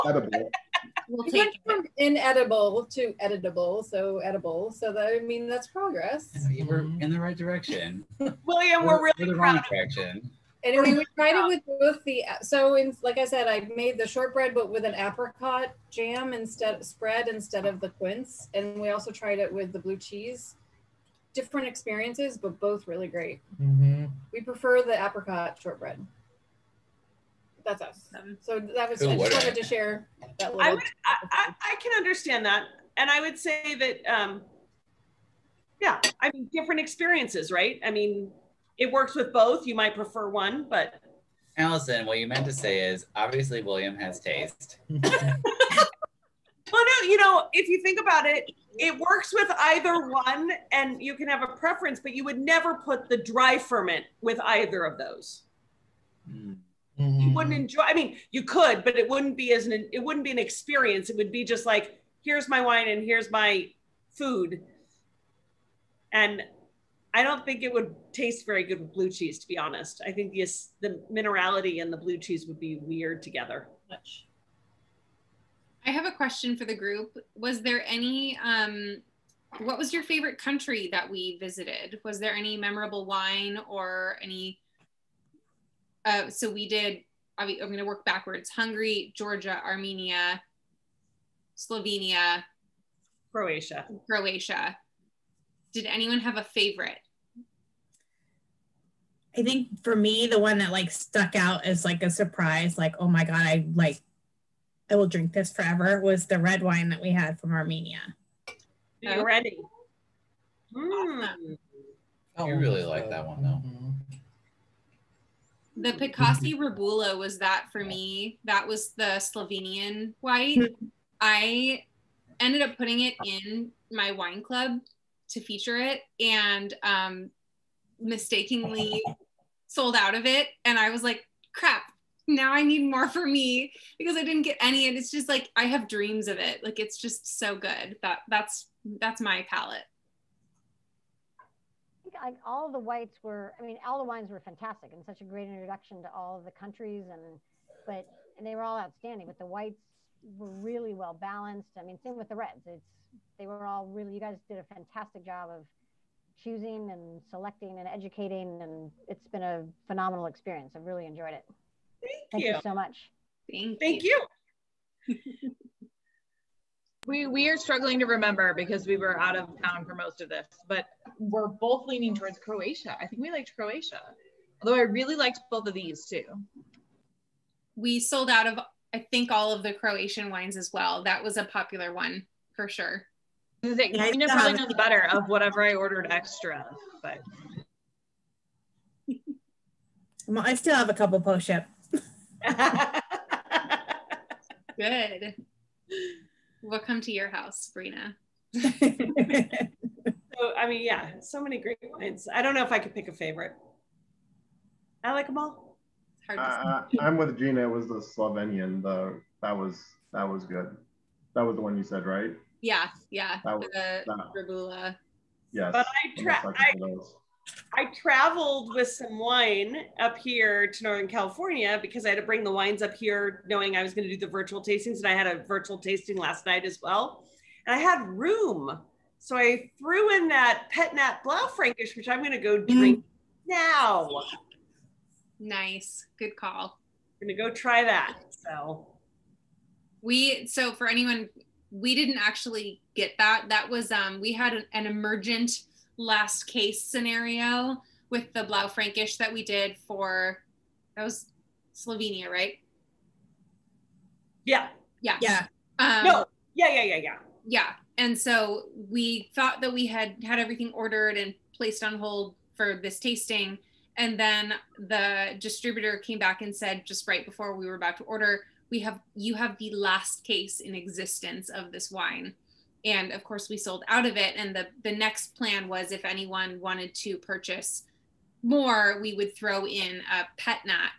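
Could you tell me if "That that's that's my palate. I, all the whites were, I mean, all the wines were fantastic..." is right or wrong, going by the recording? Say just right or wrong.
right.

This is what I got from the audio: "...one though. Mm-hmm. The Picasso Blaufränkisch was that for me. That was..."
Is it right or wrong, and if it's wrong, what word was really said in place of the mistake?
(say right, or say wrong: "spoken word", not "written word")
wrong: "Rebula", not "Blaufränkisch".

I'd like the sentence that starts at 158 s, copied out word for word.
And it's been a phenomenal experience.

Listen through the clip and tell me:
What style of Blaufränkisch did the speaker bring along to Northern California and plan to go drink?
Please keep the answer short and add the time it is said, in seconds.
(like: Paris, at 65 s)
Pet Nat, at 230 s.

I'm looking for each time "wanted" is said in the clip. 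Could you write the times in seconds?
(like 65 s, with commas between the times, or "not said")
29 s, 276 s.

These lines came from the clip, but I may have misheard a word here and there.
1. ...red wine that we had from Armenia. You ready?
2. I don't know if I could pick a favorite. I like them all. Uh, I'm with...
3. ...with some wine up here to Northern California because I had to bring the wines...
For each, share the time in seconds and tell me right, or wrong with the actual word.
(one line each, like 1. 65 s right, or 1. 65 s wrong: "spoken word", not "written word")
1. 106 s right
2. 202 s right
3. 218 s right.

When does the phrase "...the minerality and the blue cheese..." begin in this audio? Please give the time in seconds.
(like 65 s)
70 s.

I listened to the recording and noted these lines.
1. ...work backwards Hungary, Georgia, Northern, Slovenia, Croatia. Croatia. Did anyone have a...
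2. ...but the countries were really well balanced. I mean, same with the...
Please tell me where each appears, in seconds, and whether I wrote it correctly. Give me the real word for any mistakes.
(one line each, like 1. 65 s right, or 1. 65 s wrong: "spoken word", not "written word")
1. 87 s wrong: "Armenia", not "Northern"
2. 149 s wrong: "whites", not "countries".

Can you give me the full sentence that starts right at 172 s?
I think we liked Croatia, although I really liked both of these too.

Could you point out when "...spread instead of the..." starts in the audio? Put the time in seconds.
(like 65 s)
16 s.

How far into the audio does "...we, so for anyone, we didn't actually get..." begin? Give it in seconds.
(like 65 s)
240 s.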